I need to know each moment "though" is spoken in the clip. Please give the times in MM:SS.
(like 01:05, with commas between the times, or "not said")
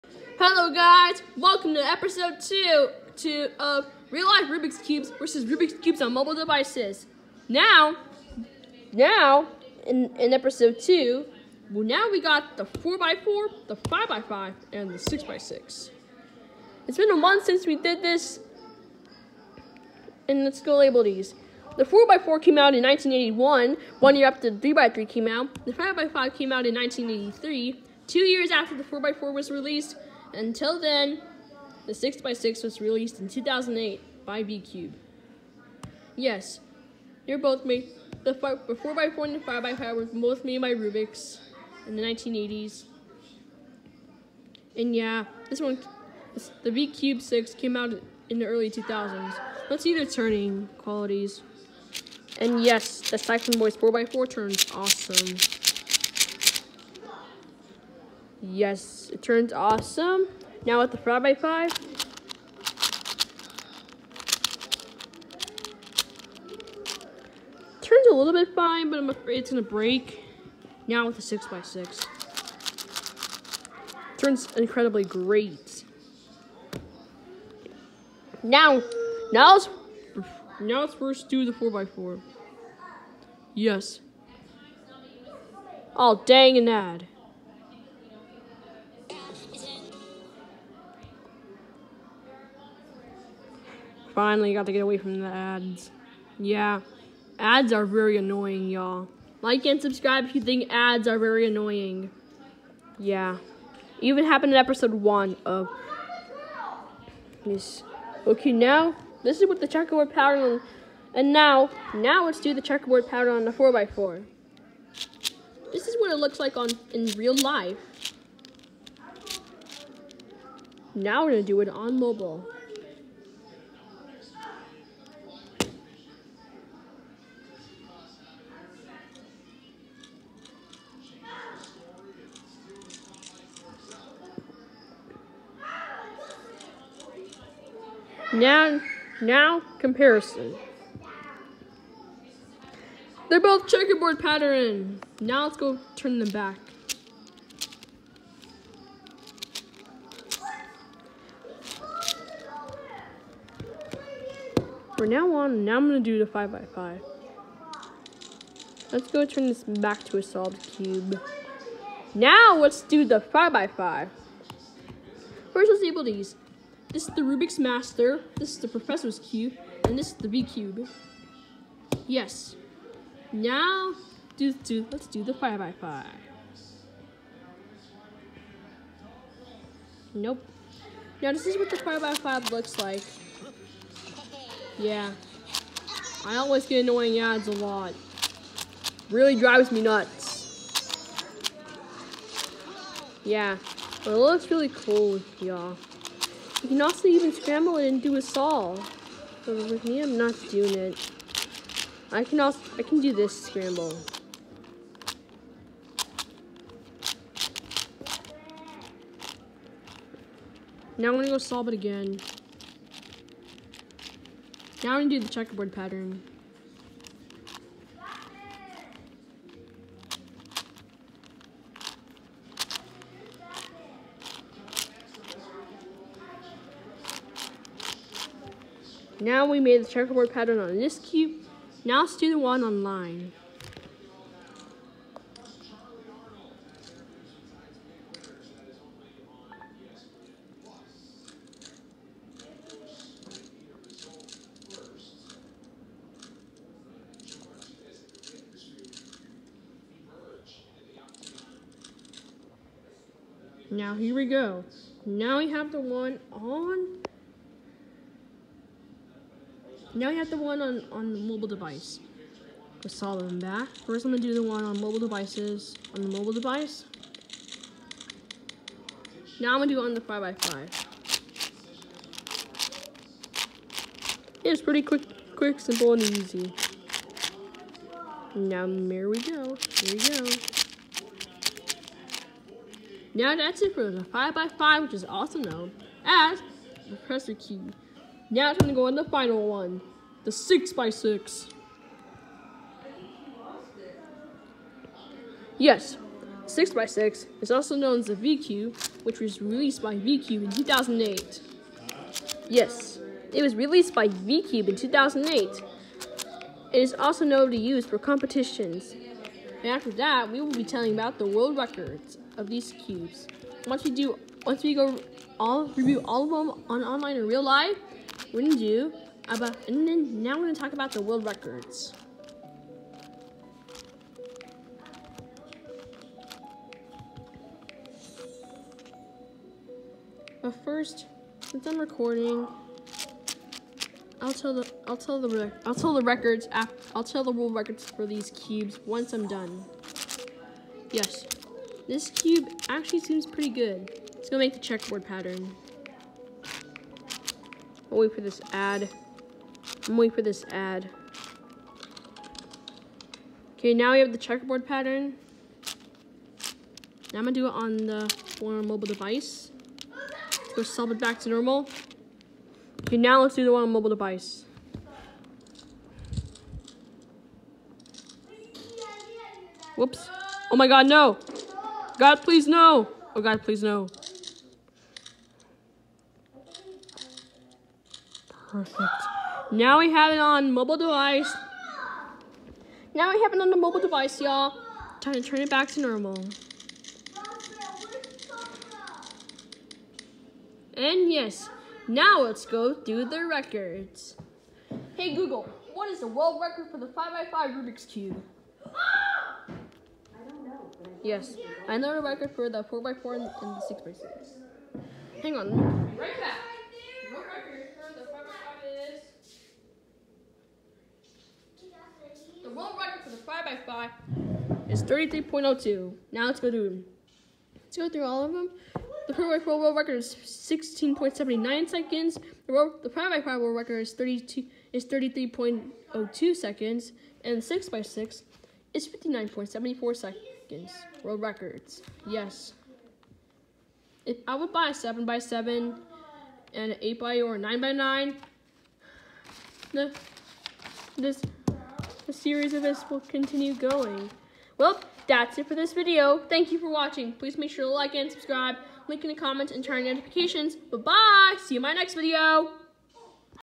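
04:45.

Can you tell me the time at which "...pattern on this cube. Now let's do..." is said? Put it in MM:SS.
03:50.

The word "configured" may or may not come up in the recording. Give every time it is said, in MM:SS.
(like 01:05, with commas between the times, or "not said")
not said.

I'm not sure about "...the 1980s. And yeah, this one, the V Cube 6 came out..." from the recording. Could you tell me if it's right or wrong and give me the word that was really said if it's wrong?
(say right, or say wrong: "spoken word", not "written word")
right.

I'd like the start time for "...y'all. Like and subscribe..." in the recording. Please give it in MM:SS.
01:38.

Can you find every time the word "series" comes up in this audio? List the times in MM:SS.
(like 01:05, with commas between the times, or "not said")
07:22.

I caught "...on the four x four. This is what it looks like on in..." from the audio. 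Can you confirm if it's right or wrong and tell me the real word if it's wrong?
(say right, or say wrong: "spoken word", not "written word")
right.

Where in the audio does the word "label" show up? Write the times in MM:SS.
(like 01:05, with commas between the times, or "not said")
00:20, 02:45.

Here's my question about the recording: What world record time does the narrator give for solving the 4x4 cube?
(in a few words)
16.79 seconds.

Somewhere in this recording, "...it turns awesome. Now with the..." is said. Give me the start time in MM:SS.
00:59.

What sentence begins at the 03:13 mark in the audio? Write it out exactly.
Yeah, but it looks really cool, y'all.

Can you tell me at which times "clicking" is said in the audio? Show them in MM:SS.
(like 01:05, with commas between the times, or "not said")
not said.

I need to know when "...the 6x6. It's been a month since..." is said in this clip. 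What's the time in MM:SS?
00:14.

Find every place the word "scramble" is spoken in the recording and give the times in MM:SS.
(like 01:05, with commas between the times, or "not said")
03:17, 03:23.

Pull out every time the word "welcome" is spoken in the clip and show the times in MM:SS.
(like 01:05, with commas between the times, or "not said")
00:01.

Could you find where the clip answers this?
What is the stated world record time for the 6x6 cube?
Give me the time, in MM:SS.
07:08.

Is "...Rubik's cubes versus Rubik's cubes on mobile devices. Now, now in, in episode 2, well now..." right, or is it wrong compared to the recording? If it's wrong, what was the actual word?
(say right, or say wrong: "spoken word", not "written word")
right.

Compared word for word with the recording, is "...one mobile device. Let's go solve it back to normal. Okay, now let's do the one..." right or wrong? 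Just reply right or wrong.
right.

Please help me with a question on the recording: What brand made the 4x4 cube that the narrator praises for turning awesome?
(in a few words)
Cyclone Boys.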